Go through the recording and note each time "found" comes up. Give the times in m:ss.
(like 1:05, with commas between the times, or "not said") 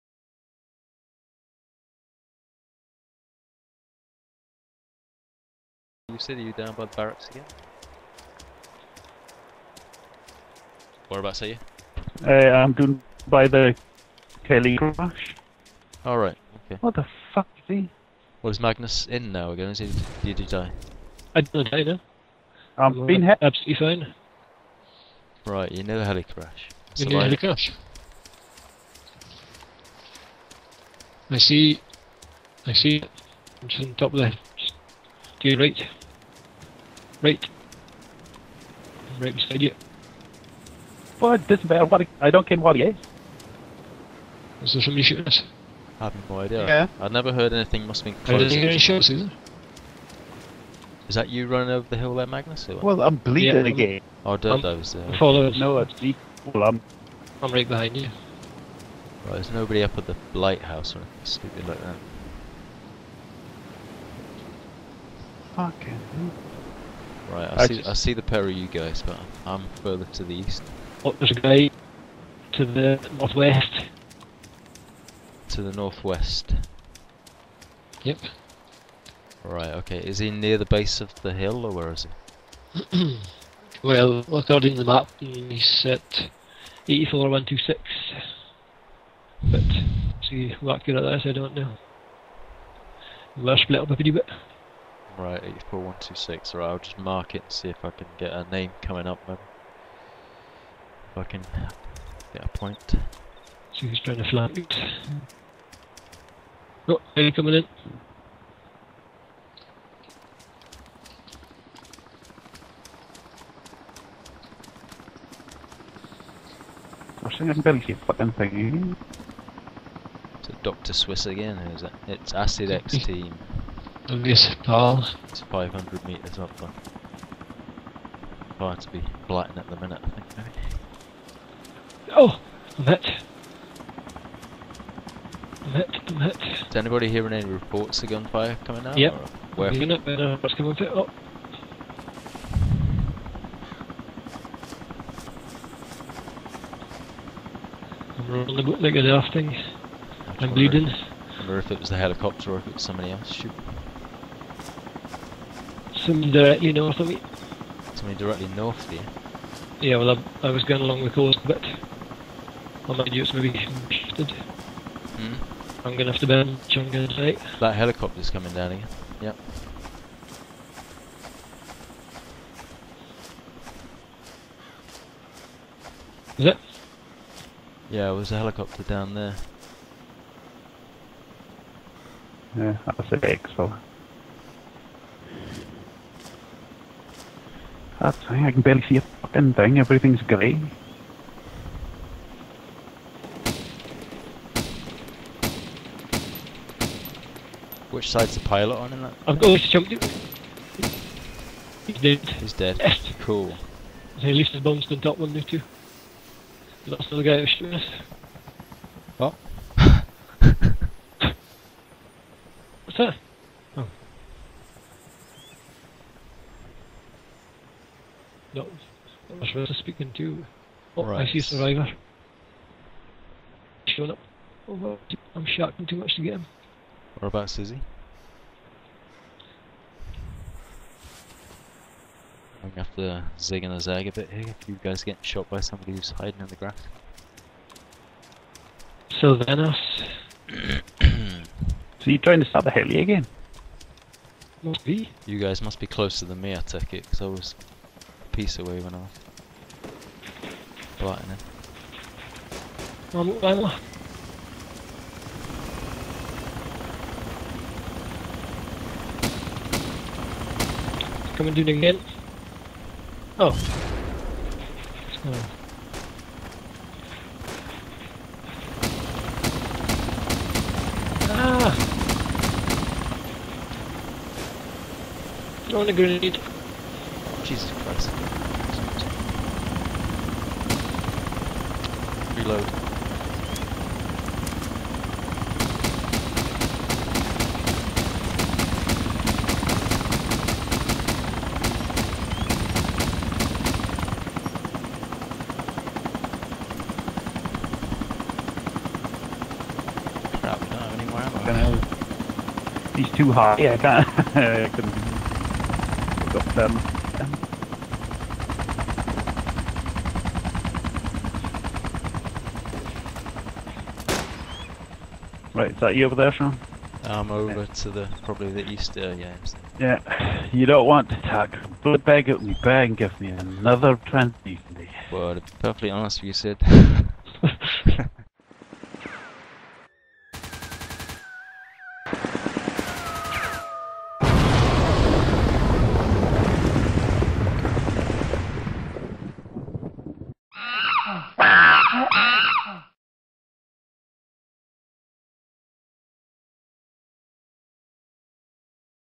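not said.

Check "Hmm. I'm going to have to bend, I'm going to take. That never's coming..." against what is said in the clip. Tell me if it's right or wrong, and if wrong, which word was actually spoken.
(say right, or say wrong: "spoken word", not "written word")
wrong: "helicopter", not "never".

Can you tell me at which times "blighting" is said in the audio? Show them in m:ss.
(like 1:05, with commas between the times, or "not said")
2:09, 4:10.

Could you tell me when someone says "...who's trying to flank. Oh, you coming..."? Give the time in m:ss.
1:43.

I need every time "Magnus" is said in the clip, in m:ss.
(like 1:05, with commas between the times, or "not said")
0:18, 0:52.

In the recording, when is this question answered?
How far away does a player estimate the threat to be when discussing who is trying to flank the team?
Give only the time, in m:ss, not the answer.
2:05.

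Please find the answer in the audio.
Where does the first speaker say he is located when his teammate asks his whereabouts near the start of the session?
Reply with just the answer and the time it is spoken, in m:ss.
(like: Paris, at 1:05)
By the heli crash, at 0:12.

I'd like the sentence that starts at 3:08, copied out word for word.
That thing, I can barely see a fucking thing, everything's grey.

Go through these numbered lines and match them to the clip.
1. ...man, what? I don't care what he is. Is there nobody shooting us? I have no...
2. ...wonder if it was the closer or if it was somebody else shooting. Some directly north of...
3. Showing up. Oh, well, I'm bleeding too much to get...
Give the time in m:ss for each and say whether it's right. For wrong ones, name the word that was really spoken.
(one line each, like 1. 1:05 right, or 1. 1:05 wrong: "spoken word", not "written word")
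1. 0:41 wrong: "somebody", not "nobody"
2. 2:31 wrong: "helicopter", not "closer"
3. 3:43 wrong: "shouting", not "bleeding".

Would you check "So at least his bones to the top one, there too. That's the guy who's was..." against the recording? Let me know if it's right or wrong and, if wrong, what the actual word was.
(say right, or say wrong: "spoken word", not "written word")
right.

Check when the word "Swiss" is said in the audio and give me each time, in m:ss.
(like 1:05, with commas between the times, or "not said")
2:00.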